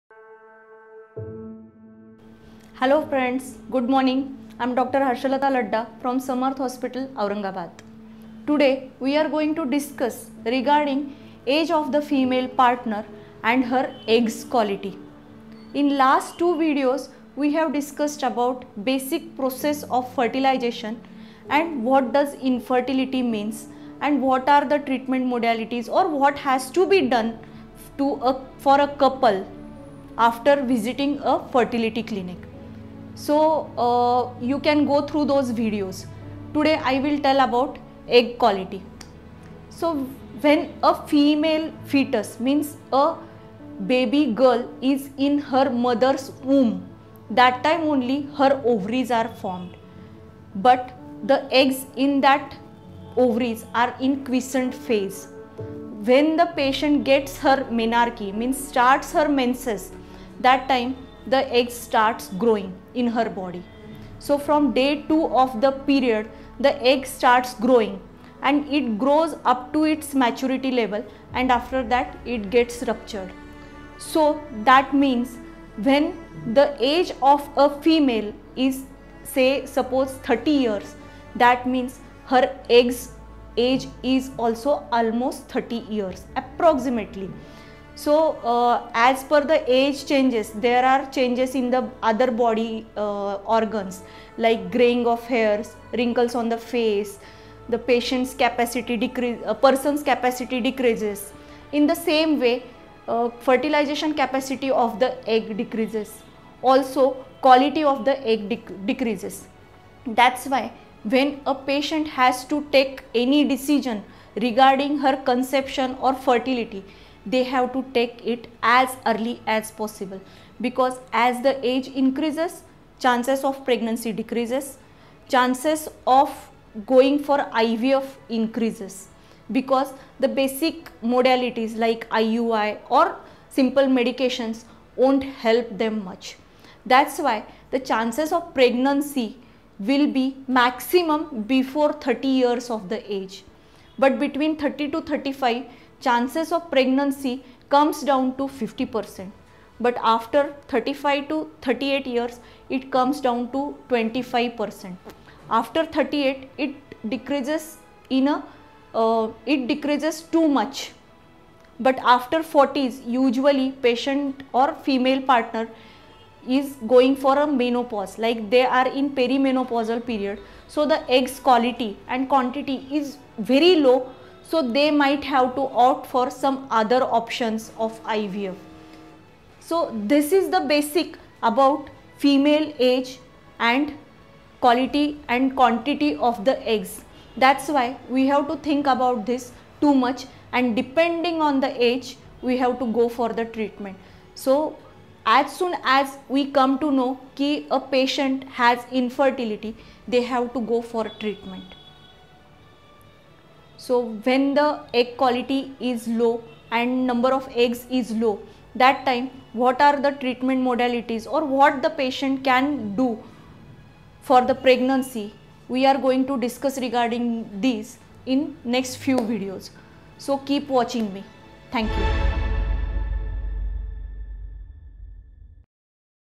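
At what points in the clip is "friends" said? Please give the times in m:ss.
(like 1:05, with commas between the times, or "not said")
0:03.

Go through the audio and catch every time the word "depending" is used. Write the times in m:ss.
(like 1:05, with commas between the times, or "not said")
3:10.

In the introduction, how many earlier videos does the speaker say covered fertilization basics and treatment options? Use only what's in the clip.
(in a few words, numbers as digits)
2.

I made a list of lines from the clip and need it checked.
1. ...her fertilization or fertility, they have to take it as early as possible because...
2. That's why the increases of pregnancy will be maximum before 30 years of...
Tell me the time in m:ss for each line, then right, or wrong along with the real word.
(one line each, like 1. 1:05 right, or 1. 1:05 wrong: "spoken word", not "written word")
1. 1:54 wrong: "conception", not "fertilization"
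2. 2:16 wrong: "chances", not "increases".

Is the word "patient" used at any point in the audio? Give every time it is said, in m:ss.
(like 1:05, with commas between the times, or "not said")
0:56, 1:37, 1:51, 2:43, 3:17, 3:31.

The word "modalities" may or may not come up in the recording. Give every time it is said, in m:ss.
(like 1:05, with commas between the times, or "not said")
0:25, 2:11, 3:30.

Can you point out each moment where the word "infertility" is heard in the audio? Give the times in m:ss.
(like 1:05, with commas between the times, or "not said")
0:22, 3:18.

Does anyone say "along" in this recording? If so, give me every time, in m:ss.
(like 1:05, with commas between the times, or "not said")
not said.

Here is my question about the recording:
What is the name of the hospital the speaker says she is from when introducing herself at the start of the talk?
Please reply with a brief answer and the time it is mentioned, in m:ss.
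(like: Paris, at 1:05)
Samarth Hospital, at 0:06.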